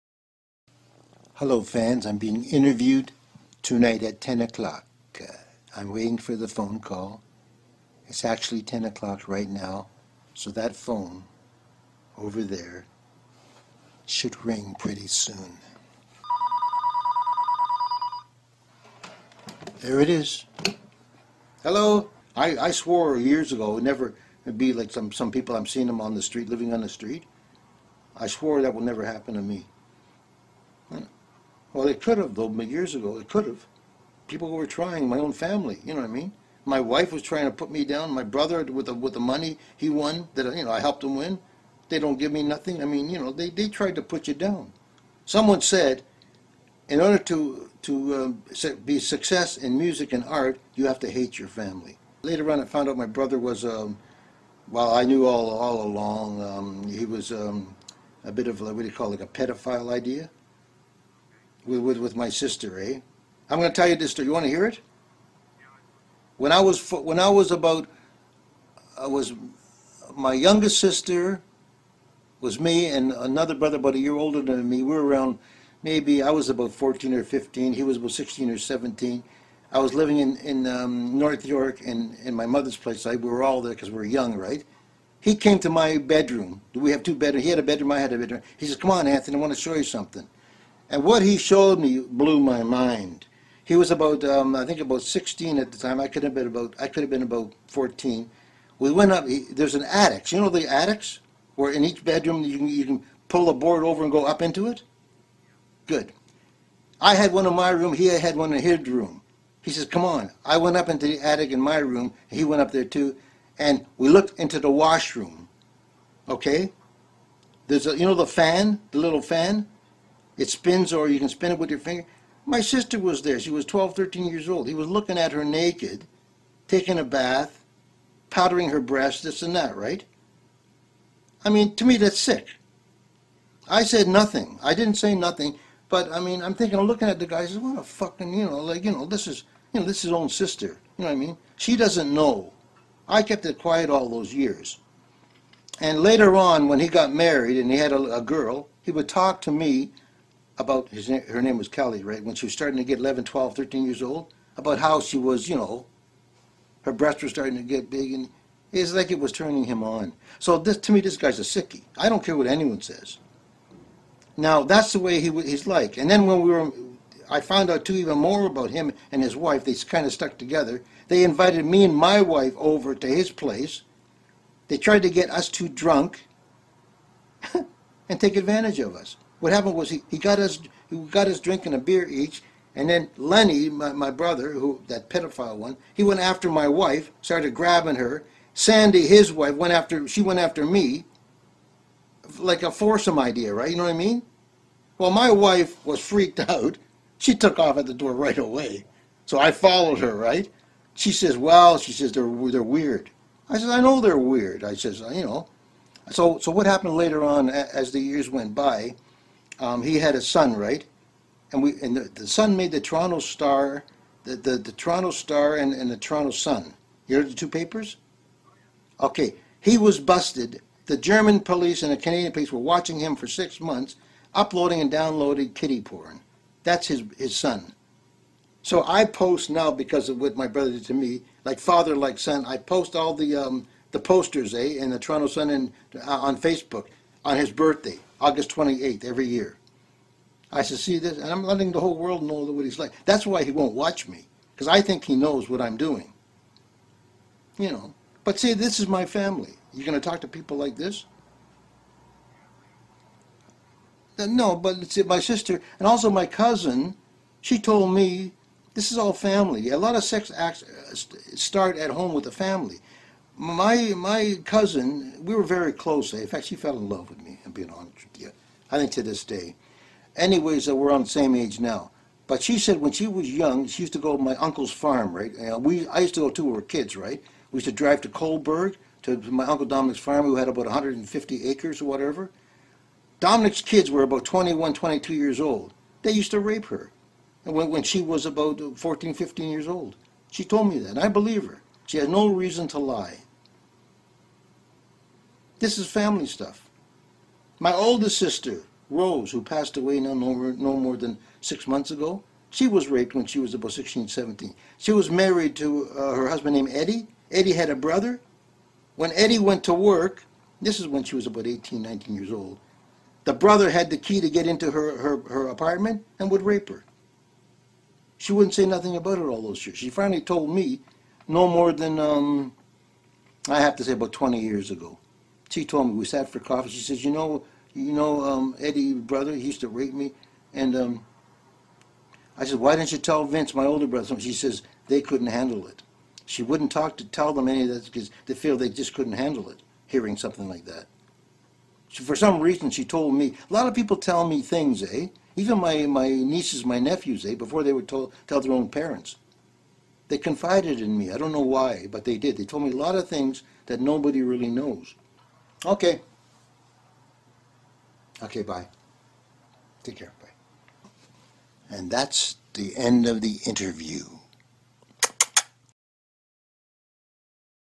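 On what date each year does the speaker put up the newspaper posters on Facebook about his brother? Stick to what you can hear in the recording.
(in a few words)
August 28th.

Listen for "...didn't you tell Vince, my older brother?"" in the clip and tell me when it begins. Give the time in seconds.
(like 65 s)
332 s.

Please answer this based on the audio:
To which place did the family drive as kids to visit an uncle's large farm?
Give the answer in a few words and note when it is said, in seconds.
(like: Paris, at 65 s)
Kohlberg, at 278 s.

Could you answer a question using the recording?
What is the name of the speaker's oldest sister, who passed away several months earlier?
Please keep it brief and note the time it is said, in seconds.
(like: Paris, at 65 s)
Rose, at 298 s.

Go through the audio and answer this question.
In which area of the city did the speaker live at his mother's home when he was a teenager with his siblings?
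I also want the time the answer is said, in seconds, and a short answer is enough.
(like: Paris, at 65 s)
North York, at 81 s.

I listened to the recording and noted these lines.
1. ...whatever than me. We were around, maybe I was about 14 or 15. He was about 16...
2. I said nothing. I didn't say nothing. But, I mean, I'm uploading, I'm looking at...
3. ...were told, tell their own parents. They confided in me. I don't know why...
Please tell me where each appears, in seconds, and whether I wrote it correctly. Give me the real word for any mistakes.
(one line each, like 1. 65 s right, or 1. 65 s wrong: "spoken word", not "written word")
1. 74 s wrong: "older", not "whatever"
2. 133 s wrong: "thinking", not "uploading"
3. 347 s right.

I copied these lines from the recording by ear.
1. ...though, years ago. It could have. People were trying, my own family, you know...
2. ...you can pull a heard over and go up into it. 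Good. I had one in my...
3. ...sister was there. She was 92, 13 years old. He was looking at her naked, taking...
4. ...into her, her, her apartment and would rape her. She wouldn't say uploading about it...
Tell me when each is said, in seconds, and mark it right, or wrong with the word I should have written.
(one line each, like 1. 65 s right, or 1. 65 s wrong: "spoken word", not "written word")
1. 32 s right
2. 102 s wrong: "board", not "heard"
3. 122 s wrong: "12", not "92"
4. 314 s wrong: "nothing", not "uploading".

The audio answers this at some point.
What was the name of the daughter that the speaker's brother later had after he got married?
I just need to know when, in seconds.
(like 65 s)
151 s.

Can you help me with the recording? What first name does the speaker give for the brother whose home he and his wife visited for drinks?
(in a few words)
Lenny.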